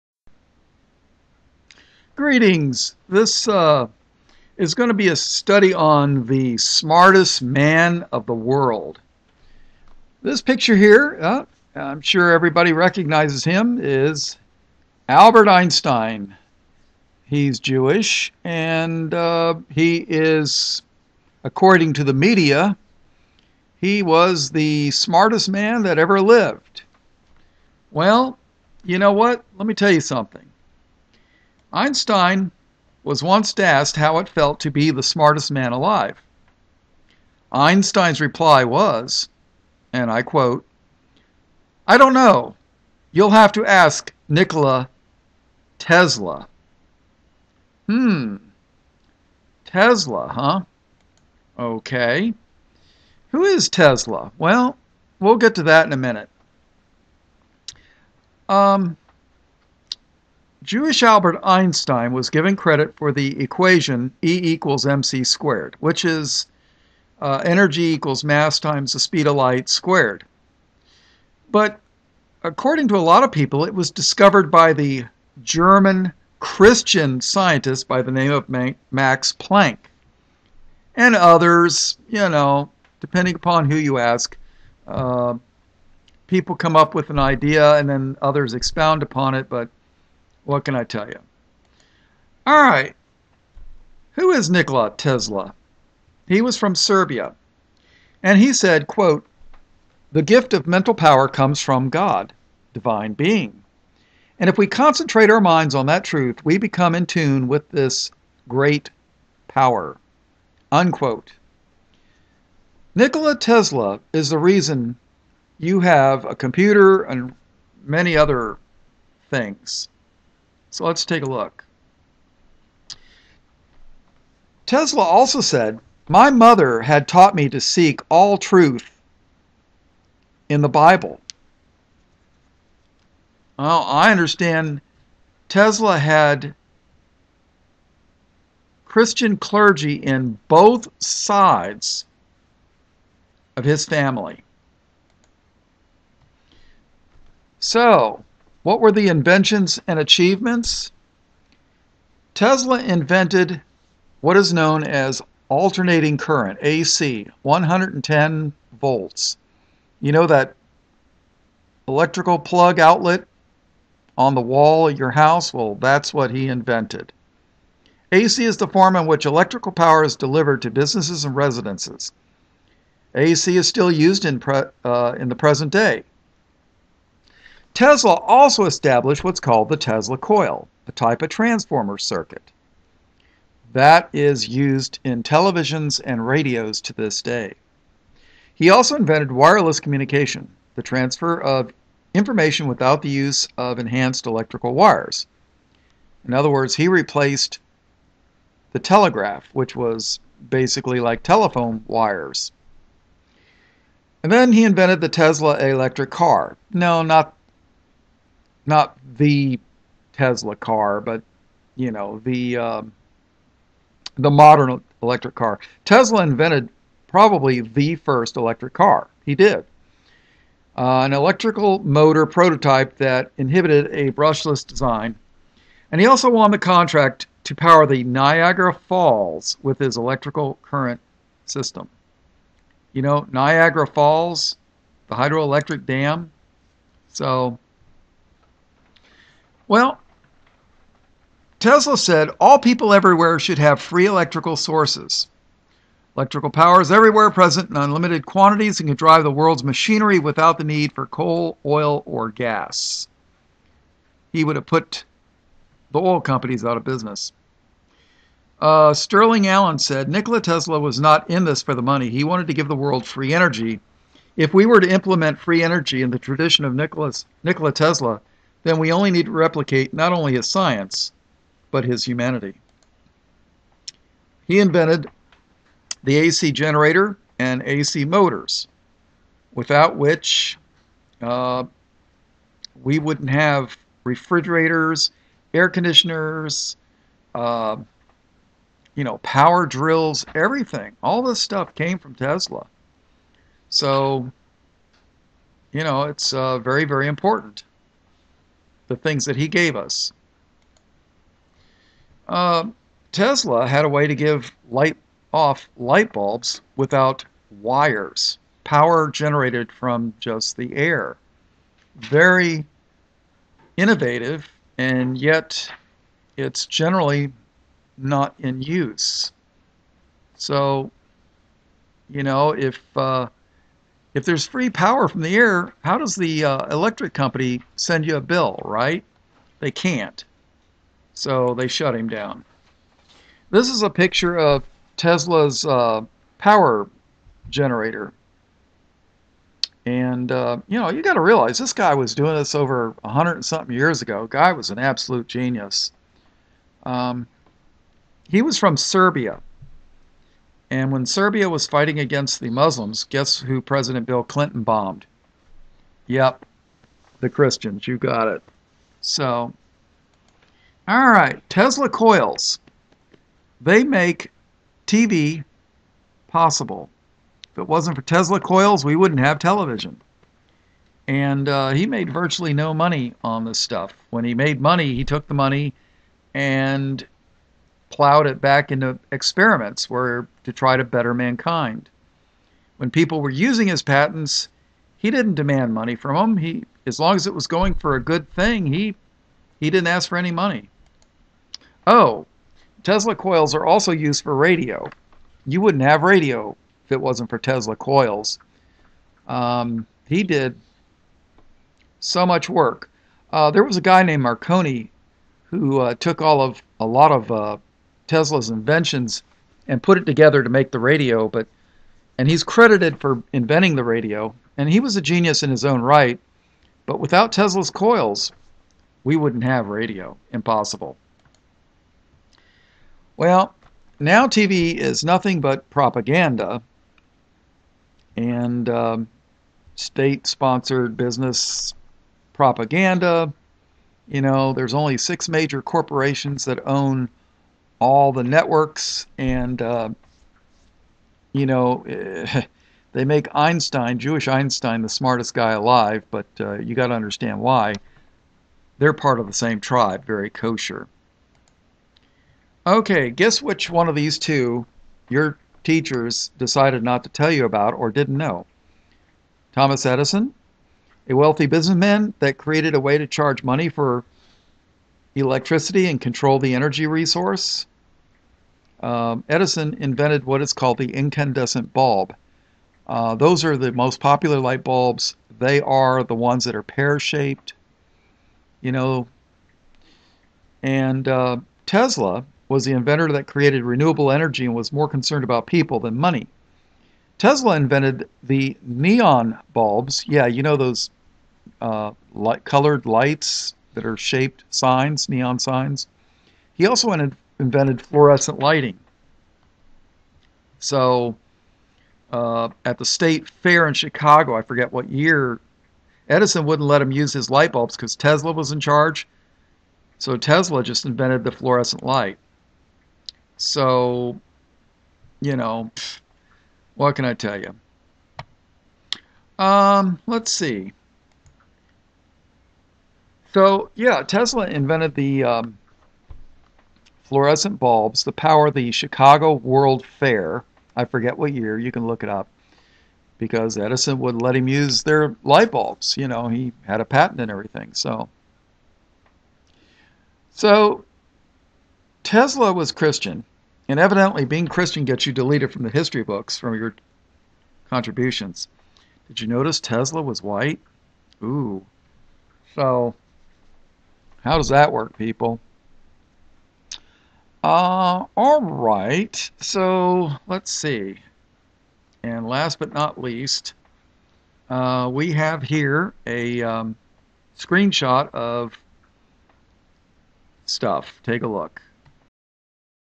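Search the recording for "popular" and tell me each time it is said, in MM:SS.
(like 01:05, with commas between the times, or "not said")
07:53.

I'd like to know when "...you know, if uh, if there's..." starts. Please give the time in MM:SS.
05:22.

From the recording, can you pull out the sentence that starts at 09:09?
Did you notice Tesla was white?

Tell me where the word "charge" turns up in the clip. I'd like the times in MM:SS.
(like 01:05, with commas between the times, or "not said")
07:43, 08:28.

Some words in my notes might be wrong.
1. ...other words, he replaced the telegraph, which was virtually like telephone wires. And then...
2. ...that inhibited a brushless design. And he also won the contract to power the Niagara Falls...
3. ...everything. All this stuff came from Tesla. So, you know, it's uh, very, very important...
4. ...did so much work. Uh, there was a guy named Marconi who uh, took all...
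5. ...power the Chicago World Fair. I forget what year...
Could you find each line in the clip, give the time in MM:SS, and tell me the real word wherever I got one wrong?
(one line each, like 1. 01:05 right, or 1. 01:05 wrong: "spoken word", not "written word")
1. 03:16 wrong: "basically", not "virtually"
2. 03:42 right
3. 04:50 right
4. 06:40 right
5. 08:48 right.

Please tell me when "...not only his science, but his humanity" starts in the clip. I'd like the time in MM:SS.
04:29.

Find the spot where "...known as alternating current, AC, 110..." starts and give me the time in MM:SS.
02:34.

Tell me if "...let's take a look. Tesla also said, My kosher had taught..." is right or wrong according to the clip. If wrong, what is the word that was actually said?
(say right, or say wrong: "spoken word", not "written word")
wrong: "mother", not "kosher".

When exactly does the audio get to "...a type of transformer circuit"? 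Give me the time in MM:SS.
03:00.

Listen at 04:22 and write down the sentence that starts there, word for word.
He wanted to give the world free energy.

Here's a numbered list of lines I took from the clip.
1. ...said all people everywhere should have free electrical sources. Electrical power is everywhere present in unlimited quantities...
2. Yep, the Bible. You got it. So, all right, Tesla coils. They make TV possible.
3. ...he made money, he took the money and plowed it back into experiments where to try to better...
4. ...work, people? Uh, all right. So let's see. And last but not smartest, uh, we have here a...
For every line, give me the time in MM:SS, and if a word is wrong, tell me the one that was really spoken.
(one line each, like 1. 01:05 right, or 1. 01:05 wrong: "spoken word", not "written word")
1. 04:01 right
2. 05:56 wrong: "Christians", not "Bible"
3. 06:14 right
4. 09:14 wrong: "least", not "smartest".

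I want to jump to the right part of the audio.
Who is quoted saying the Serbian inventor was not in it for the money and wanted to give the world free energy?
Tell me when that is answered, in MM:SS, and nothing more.
04:18.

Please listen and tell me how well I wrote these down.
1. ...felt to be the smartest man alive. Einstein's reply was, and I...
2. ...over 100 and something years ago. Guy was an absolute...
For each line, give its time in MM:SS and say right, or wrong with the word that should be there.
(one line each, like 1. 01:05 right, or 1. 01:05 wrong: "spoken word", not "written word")
1. 00:34 right
2. 05:42 right.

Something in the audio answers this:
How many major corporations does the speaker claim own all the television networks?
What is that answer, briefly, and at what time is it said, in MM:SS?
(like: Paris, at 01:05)
6, at 07:14.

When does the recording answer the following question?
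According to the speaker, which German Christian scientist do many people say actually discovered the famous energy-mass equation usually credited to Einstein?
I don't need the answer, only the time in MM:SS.
01:18.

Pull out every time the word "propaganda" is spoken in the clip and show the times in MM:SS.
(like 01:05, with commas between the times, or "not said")
07:05, 07:12.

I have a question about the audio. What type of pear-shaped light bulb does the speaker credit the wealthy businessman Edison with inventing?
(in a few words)
incandescent bulb.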